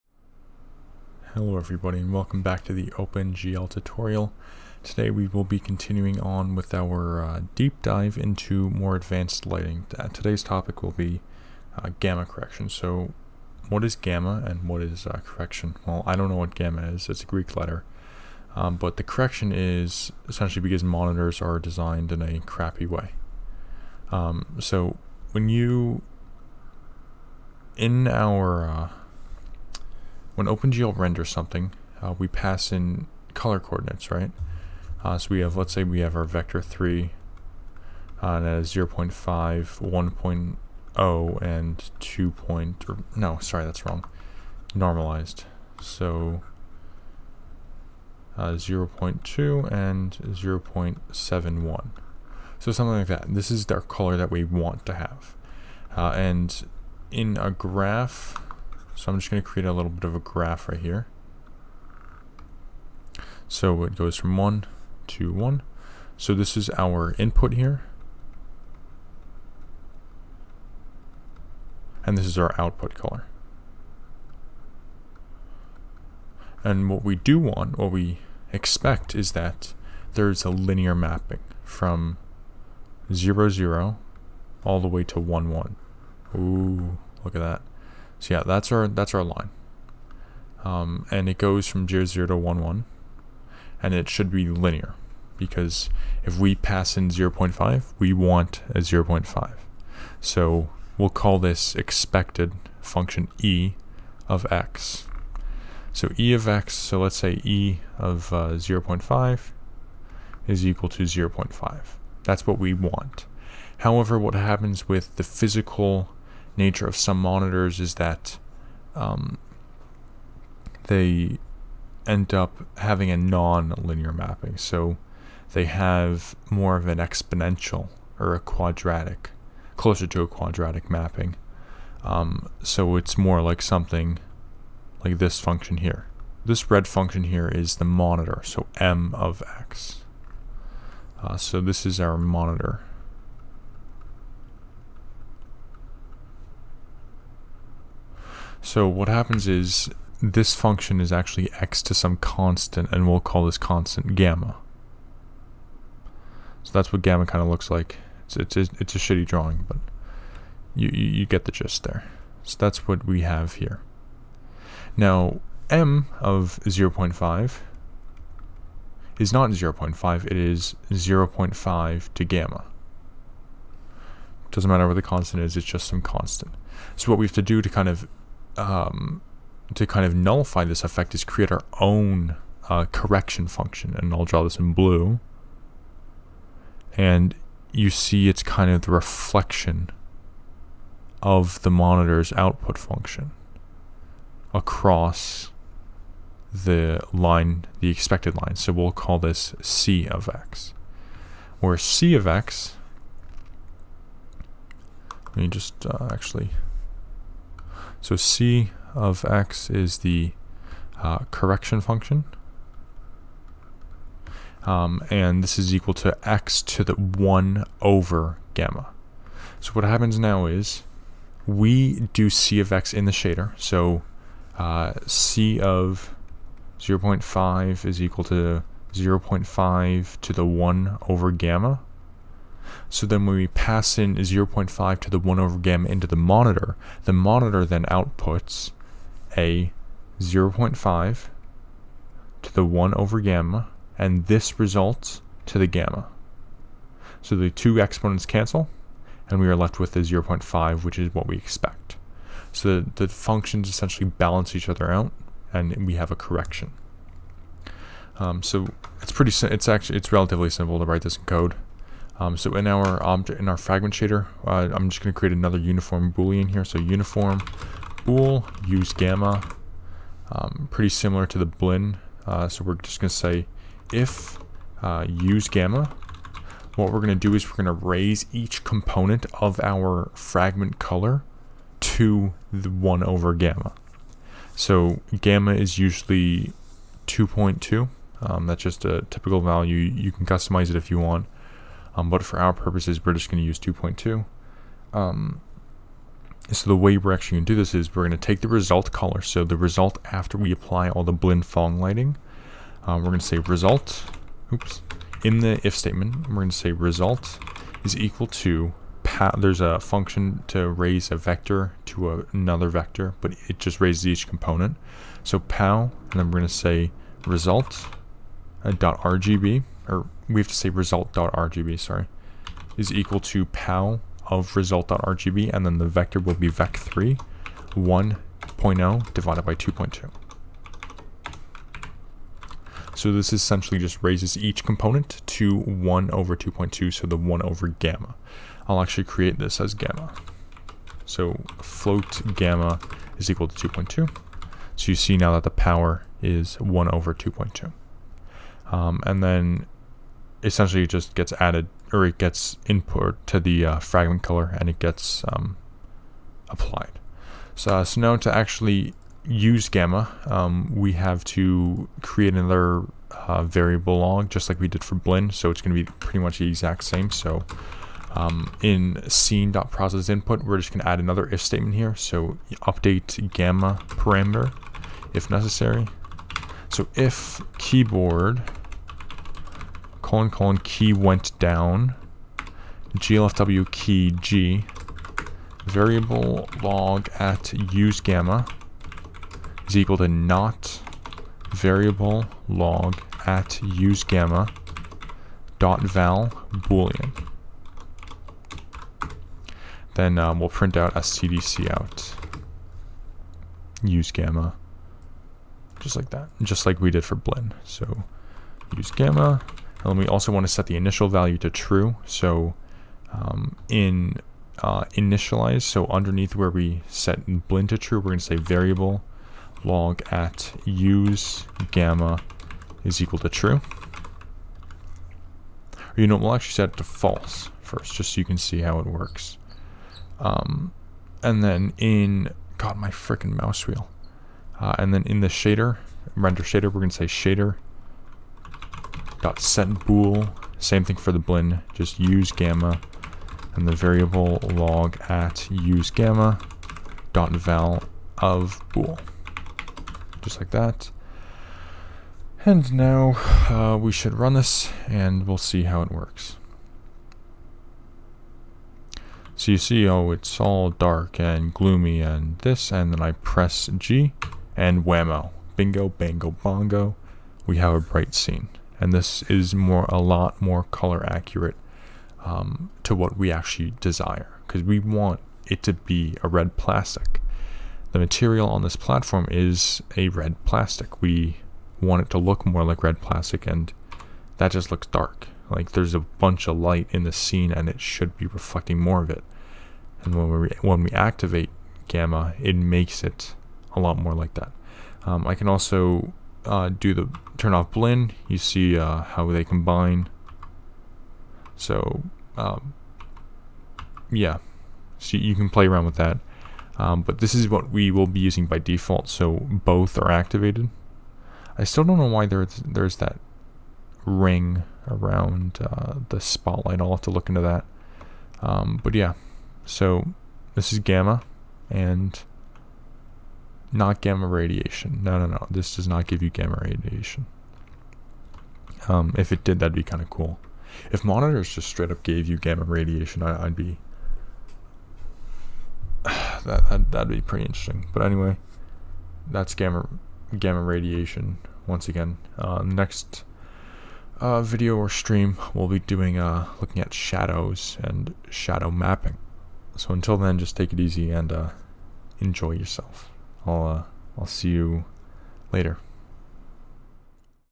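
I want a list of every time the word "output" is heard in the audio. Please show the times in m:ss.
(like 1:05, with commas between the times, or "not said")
1:12, 3:12, 3:57.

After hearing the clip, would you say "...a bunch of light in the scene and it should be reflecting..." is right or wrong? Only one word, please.
right.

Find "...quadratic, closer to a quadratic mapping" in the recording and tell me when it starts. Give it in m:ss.
2:08.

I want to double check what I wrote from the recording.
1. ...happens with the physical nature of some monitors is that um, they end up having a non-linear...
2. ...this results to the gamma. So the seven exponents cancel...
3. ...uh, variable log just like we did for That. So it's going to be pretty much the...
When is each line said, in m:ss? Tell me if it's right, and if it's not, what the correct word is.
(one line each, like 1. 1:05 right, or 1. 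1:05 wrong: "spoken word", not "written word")
1. 1:54 right
2. 4:04 wrong: "two", not "seven"
3. 6:03 wrong: "Blinn", not "That".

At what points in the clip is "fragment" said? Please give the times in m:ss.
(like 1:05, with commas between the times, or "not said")
4:23, 4:40, 5:53.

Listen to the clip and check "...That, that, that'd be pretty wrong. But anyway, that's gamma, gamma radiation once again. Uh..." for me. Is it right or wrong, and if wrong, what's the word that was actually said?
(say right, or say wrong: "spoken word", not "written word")
wrong: "interesting", not "wrong".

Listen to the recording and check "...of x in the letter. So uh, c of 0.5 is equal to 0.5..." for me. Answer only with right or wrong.
wrong.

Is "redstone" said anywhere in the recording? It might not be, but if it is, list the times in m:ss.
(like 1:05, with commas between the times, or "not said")
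not said.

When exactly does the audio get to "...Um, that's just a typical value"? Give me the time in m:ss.
4:48.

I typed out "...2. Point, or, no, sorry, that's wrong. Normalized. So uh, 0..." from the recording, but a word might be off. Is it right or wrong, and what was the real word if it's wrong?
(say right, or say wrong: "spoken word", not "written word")
right.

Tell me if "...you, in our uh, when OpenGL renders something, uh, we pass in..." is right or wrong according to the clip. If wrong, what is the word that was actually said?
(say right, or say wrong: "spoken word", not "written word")
right.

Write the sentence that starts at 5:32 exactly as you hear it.
So this essentially just raises each component to 1 over 2.2, so the 1 over gamma.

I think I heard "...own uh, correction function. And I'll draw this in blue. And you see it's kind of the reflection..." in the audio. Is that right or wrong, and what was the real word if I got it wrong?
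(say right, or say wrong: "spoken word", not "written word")
right.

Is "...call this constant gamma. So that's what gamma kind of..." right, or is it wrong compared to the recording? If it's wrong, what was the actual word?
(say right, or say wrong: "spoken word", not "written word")
right.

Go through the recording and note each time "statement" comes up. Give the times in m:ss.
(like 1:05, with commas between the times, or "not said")
5:05, 6:11.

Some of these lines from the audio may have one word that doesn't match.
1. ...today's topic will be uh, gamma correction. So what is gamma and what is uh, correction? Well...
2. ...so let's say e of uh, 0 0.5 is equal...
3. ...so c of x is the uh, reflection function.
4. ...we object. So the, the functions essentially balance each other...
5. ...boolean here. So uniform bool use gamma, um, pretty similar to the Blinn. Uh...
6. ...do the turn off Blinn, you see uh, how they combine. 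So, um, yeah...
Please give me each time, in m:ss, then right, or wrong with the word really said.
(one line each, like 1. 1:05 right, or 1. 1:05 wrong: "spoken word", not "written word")
1. 0:10 right
2. 1:46 right
3. 3:28 wrong: "correction", not "reflection"
4. 4:11 wrong: "expect", not "object"
5. 4:26 right
6. 8:16 right.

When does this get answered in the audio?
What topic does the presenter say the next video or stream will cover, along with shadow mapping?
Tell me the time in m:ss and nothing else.
9:06.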